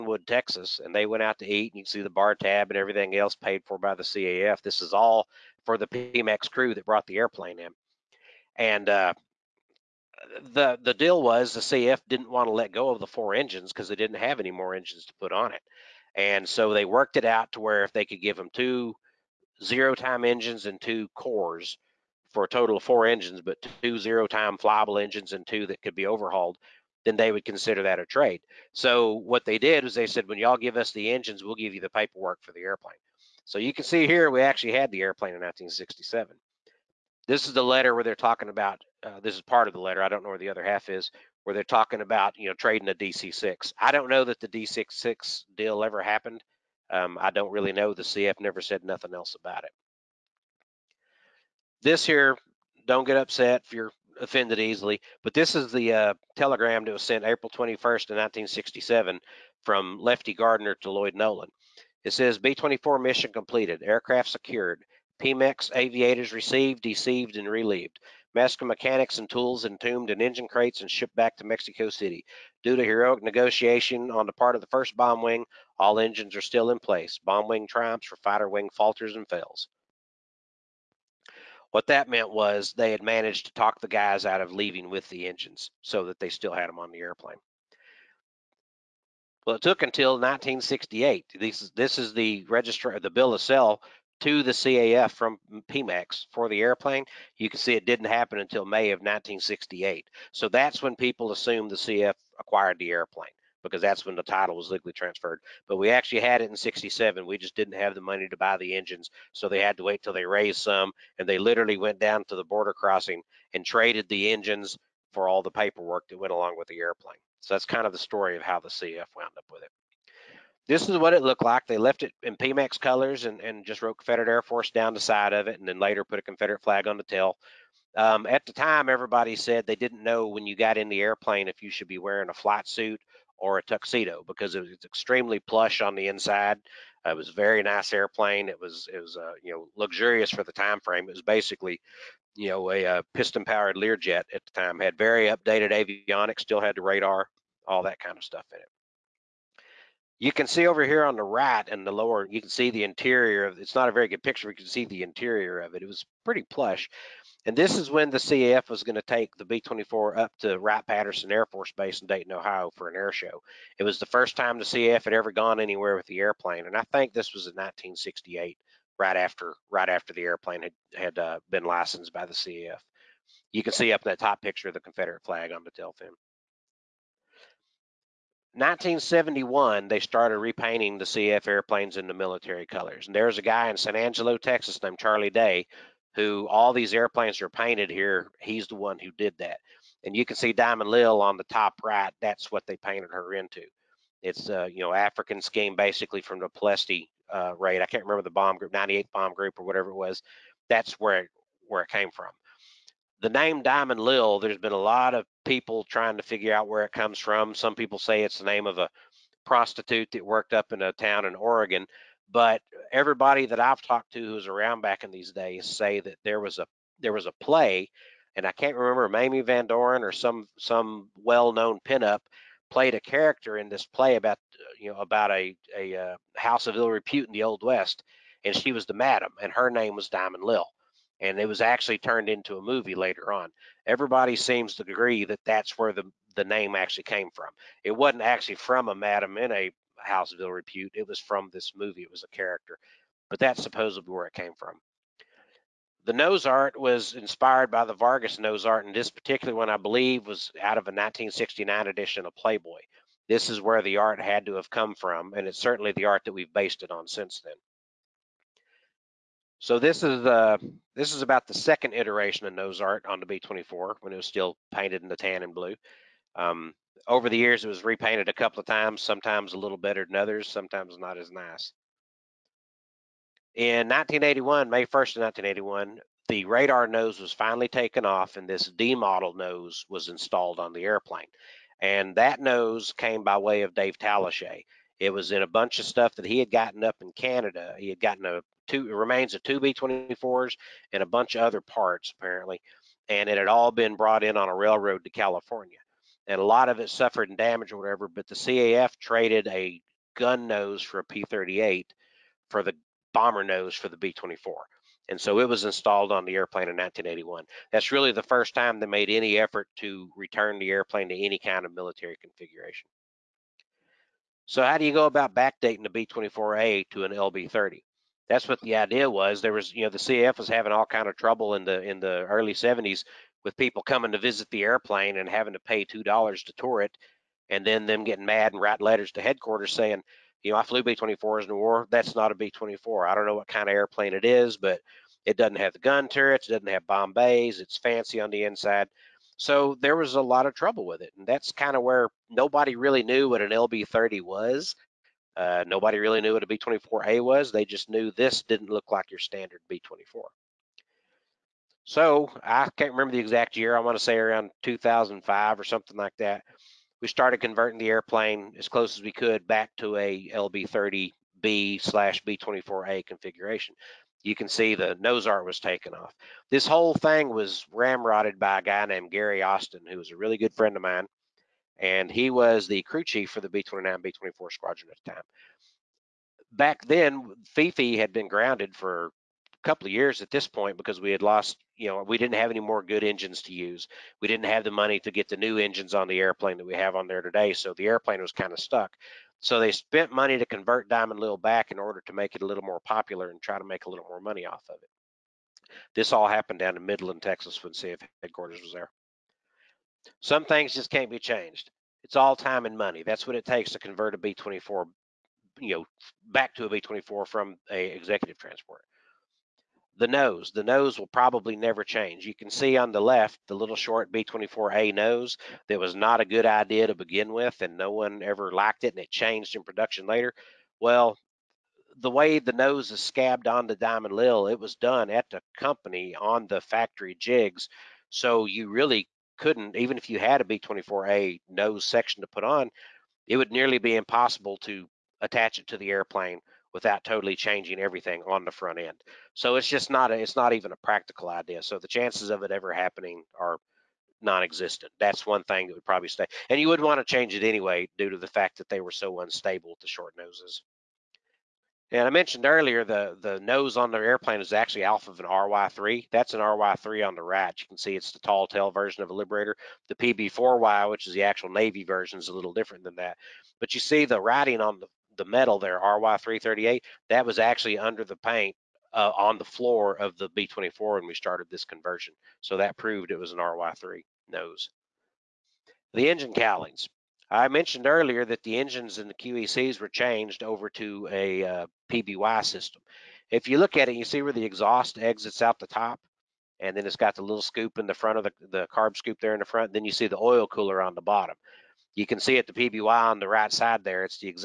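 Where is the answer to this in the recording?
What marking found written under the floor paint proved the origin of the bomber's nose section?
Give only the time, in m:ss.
7:45.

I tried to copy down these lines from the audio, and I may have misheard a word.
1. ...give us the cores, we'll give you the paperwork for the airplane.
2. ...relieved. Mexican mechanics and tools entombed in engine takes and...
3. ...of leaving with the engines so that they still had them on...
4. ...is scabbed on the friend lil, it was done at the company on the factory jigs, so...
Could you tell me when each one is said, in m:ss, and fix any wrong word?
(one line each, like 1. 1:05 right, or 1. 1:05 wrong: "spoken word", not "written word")
1. 0:30 wrong: "engines", not "cores"
2. 1:07 wrong: "crates", not "takes"
3. 1:24 right
4. 7:02 wrong: "diamond", not "friend".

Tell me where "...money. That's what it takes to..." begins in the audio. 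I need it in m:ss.
6:42.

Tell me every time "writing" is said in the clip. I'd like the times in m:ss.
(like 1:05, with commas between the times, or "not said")
5:28, 7:44.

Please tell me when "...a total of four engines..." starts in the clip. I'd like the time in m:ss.
0:22.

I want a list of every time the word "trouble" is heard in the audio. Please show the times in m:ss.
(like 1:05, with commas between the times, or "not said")
5:21, 5:40.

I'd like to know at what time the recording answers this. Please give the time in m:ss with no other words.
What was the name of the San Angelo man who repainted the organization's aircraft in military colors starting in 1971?
3:04.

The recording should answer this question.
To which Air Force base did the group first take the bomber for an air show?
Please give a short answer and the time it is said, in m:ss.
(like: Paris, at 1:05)
Wright-Patterson Air Force Base, at 2:40.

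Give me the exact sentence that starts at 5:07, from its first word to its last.
That's really the first time they made any effort to return the airplane to any kind of military configuration.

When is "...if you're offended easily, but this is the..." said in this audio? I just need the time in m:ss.
0:53.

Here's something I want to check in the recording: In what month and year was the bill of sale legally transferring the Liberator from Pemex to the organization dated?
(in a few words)
May 1968.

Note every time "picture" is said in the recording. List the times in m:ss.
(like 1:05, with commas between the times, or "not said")
2:34, 2:54.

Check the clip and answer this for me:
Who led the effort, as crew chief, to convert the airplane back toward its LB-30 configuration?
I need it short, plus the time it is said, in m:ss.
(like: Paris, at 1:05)
Gary Austin, at 6:09.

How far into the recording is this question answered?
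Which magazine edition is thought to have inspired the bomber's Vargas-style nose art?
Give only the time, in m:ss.
4:10.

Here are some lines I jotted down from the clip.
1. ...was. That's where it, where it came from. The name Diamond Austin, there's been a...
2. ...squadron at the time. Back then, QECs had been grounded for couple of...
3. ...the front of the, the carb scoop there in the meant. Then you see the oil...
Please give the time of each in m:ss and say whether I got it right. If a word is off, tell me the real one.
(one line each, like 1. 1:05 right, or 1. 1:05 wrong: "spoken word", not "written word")
1. 3:19 wrong: "Lil", not "Austin"
2. 6:14 wrong: "Fifi", not "QECs"
3. 8:07 wrong: "front", not "meant".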